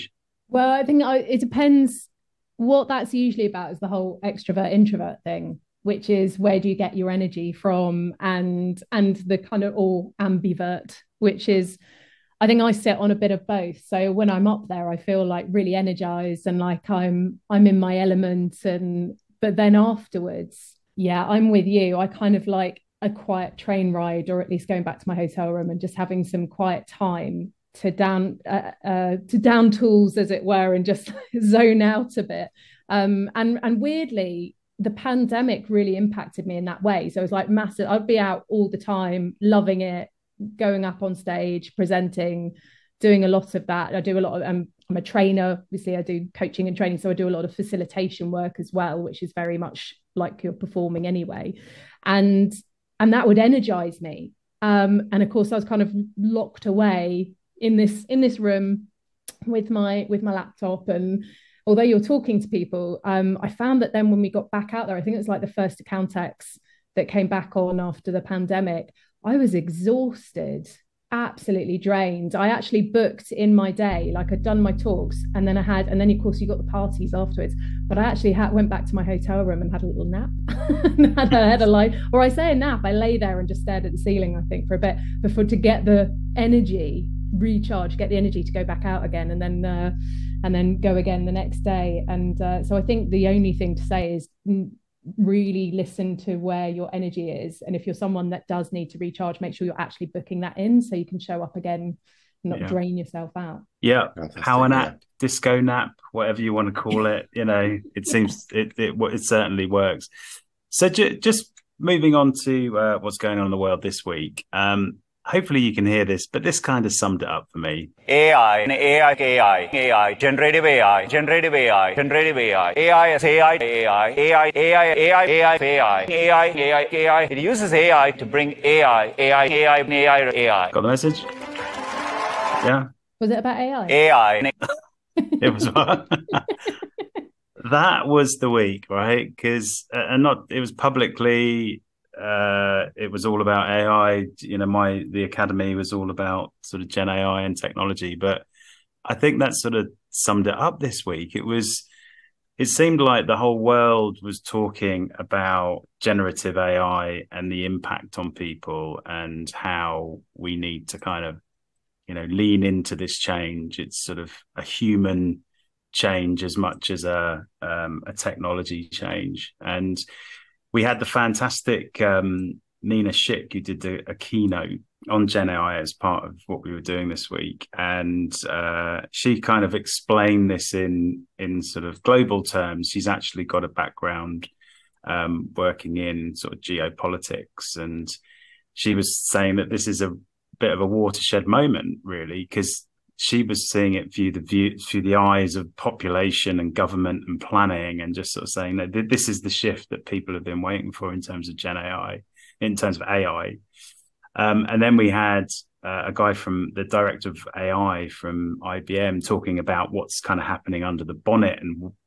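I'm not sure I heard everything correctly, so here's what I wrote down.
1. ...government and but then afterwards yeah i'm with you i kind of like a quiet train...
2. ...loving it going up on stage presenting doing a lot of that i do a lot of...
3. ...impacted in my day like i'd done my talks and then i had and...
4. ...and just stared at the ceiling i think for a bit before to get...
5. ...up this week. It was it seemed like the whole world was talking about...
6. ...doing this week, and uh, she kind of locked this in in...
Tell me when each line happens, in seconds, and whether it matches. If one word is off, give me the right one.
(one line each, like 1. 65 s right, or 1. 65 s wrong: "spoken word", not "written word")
1. 17 s wrong: "element", not "government"
2. 39 s right
3. 72 s wrong: "booked", not "impacted"
4. 83 s right
5. 150 s right
6. 176 s wrong: "explained", not "locked".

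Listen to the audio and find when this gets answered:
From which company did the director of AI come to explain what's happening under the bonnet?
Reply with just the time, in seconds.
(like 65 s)
208 s.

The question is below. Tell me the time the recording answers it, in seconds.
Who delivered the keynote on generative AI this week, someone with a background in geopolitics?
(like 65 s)
172 s.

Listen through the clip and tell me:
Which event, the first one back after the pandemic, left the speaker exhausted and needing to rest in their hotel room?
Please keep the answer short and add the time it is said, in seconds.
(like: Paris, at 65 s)
Accountex, at 65 s.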